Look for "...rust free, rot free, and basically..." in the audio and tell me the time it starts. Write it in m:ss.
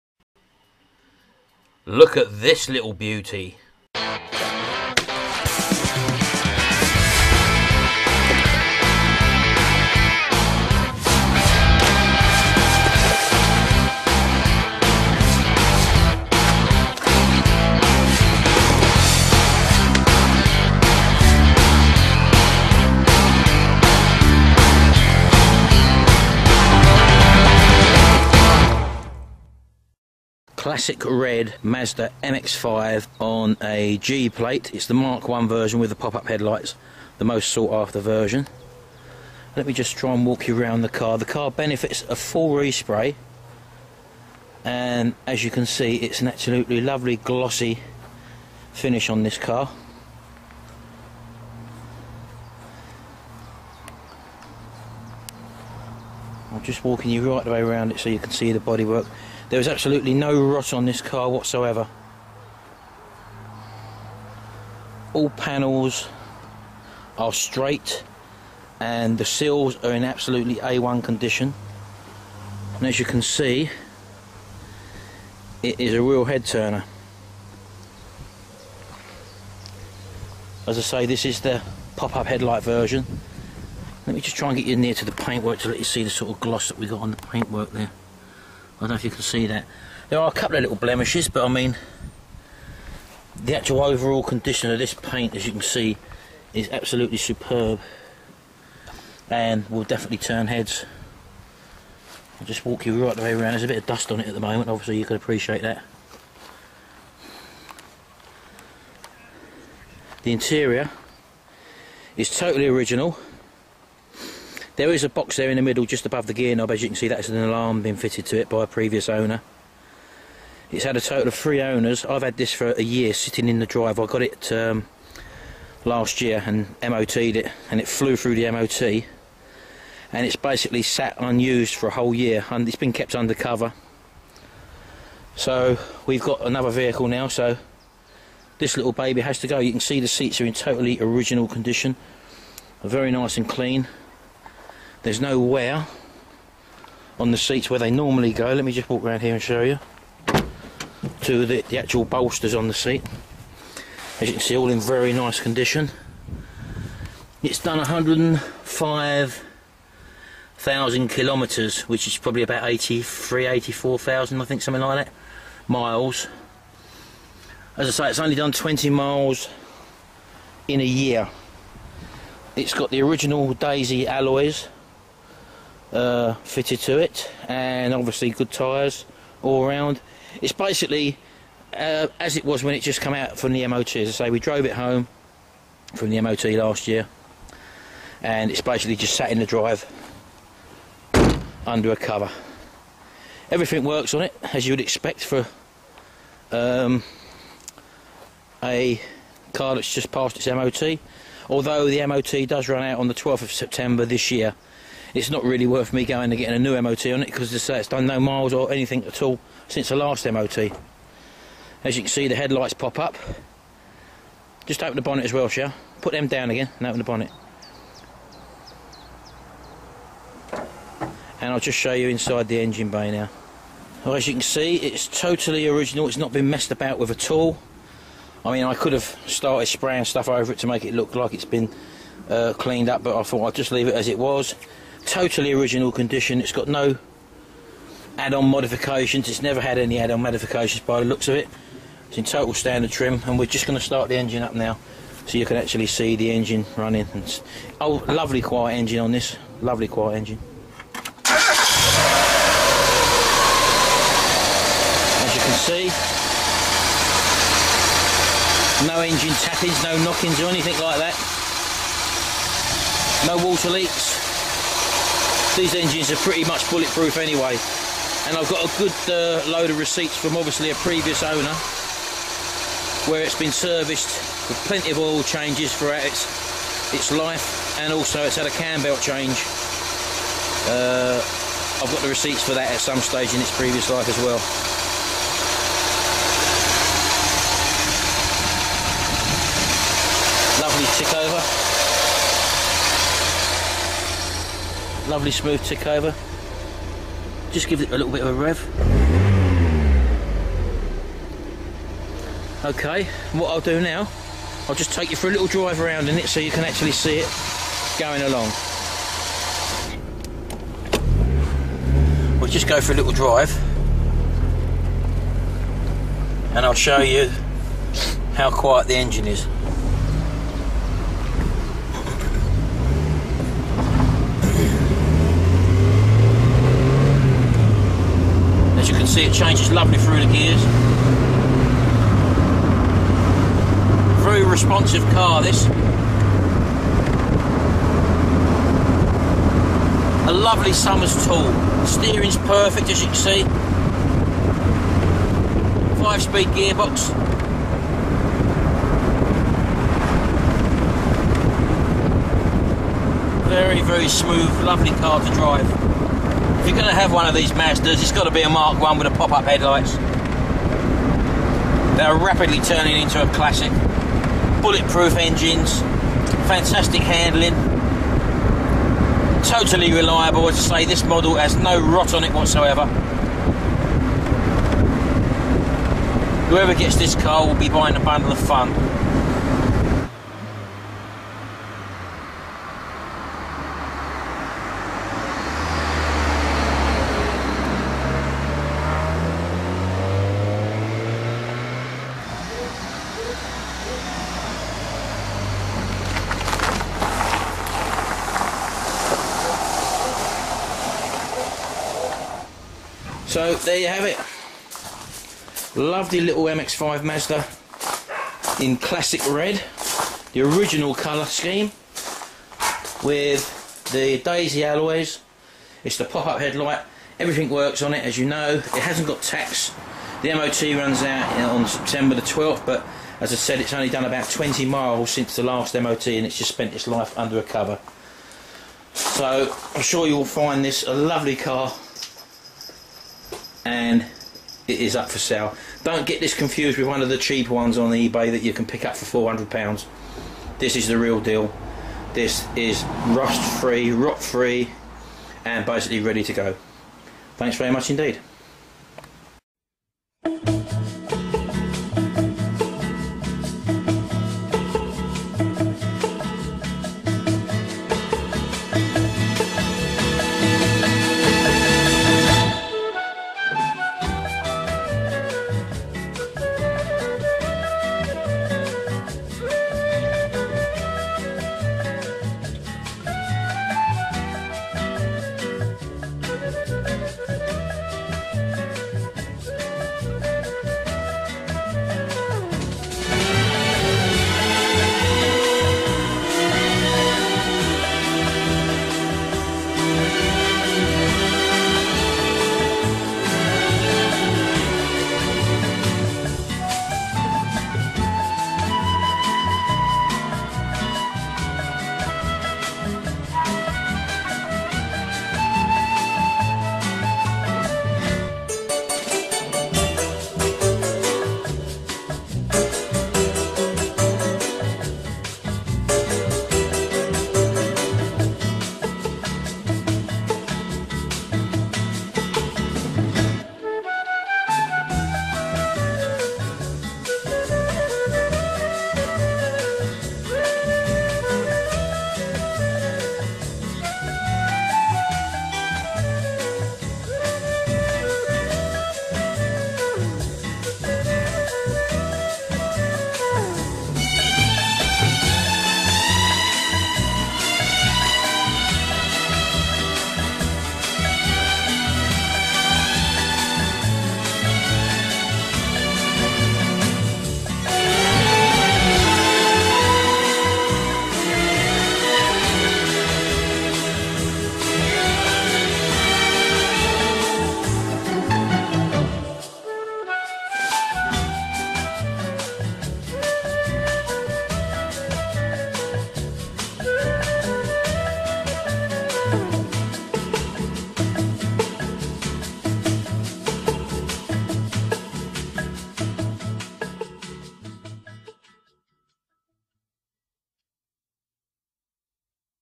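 7:23.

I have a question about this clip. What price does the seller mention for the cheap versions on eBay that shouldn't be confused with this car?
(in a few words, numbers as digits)
£400.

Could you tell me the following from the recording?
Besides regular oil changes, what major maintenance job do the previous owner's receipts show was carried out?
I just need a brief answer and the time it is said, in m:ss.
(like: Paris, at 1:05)
cam belt change, at 4:38.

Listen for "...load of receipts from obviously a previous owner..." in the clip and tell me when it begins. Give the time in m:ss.
4:29.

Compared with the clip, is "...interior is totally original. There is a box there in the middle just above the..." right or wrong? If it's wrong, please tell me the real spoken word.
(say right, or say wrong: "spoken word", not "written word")
right.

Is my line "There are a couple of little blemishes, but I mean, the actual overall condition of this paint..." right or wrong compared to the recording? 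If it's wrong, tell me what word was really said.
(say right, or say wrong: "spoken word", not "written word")
right.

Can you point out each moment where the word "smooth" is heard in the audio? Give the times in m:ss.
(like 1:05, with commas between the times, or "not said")
4:55, 5:54.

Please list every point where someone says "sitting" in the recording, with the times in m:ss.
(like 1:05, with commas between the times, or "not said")
2:03.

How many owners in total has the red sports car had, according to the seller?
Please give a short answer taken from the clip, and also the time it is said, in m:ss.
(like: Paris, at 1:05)
3, at 2:01.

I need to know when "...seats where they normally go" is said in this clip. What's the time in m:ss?
2:27.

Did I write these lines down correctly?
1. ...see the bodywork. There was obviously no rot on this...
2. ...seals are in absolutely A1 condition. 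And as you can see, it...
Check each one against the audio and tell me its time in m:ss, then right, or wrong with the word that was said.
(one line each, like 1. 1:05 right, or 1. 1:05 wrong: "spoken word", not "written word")
1. 0:58 wrong: "absolutely", not "obviously"
2. 1:09 right.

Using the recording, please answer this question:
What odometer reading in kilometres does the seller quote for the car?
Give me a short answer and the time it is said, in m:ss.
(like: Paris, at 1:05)
105,000 kilometres, at 2:37.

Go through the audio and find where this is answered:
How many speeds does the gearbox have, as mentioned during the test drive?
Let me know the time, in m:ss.
5:46.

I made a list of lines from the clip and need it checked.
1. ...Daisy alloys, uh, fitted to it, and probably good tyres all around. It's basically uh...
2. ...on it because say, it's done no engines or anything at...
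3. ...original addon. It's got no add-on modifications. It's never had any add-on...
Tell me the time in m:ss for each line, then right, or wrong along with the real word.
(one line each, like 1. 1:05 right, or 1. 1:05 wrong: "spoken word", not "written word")
1. 2:53 wrong: "obviously", not "probably"
2. 3:27 wrong: "miles", not "engines"
3. 3:55 wrong: "condition", not "addon".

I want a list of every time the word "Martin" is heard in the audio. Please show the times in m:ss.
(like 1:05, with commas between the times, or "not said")
not said.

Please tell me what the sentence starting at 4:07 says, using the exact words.
oh, lovely quiet engine on this.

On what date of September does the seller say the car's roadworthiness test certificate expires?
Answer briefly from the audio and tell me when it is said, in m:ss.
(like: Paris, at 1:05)
12th, at 3:23.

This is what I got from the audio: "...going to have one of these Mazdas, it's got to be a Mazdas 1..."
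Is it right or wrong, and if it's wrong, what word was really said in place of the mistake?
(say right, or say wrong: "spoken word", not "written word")
wrong: "Mark", not "Mazdas".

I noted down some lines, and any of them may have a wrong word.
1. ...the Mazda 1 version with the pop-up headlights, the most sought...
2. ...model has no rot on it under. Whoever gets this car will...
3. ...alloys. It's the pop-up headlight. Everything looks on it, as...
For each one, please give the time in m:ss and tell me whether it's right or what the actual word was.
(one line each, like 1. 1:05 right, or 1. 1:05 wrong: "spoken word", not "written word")
1. 0:34 wrong: "Mark", not "Mazda"
2. 6:11 wrong: "whatsoever", not "under"
3. 6:54 wrong: "works", not "looks".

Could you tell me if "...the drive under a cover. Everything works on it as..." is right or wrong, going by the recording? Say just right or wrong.
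right.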